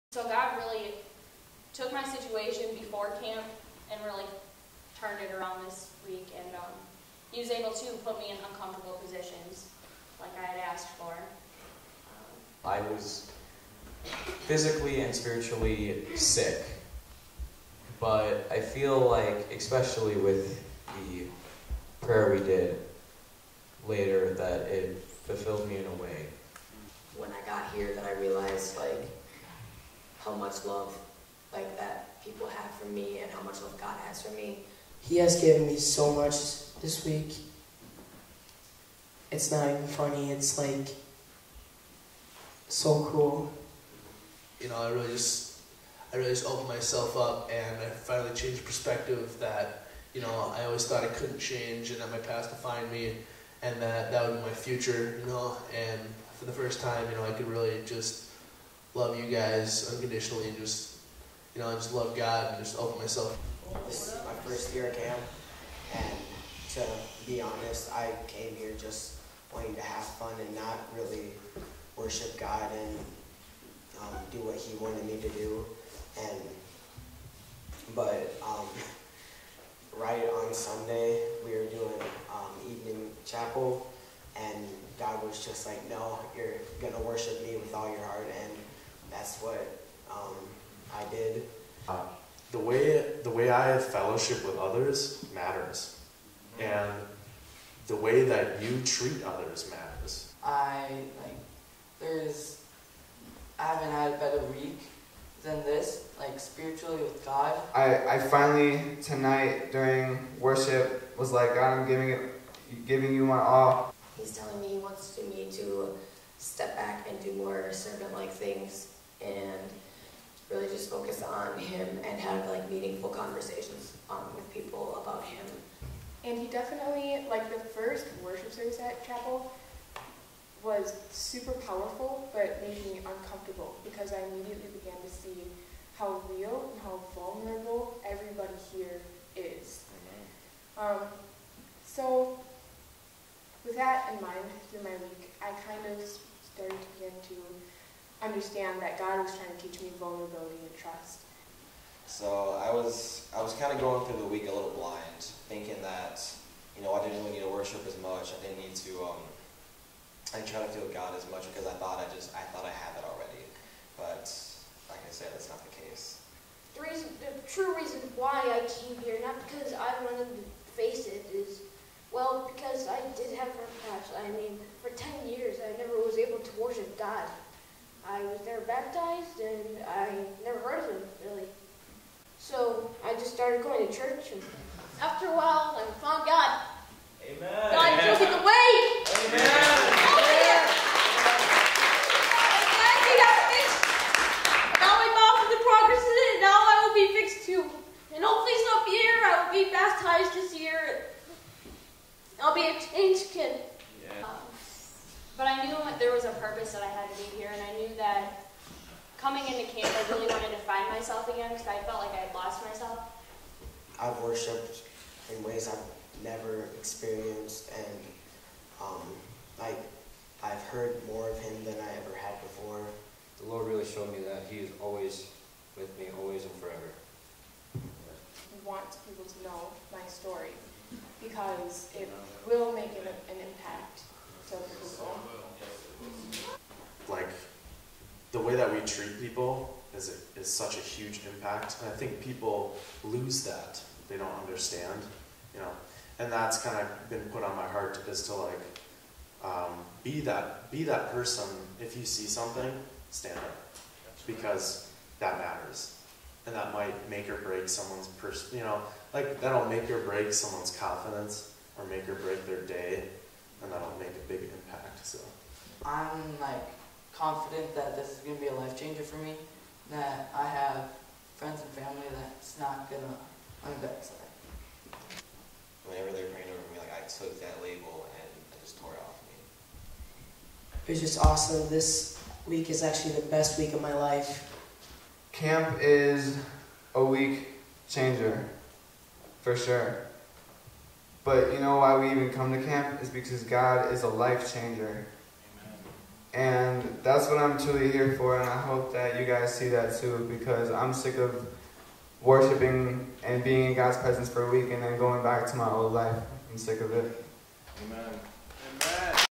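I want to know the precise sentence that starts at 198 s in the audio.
And hopefully some year I will be baptized this year.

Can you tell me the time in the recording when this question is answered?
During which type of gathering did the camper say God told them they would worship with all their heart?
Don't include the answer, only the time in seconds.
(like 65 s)
82 s.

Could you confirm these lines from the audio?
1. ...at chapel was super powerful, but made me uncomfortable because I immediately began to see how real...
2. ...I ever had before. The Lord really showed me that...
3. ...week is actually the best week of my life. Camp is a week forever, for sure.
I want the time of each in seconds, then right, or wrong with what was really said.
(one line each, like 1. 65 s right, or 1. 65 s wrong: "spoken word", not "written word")
1. 128 s right
2. 221 s right
3. 282 s wrong: "changer", not "forever".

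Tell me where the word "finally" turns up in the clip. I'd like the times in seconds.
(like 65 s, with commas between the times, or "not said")
47 s, 108 s.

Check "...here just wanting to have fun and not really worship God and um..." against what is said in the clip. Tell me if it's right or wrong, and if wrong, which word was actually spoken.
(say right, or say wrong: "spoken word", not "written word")
right.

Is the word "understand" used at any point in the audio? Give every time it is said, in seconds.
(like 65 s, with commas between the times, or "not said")
148 s, 244 s.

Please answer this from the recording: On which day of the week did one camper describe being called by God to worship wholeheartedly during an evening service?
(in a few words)
Sunday.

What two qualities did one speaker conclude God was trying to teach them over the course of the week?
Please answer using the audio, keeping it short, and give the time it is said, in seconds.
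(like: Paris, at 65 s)
vulnerability and trust, at 149 s.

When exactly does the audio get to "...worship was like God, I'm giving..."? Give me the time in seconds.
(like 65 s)
110 s.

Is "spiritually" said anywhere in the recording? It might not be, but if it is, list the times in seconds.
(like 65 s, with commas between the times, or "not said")
15 s, 106 s.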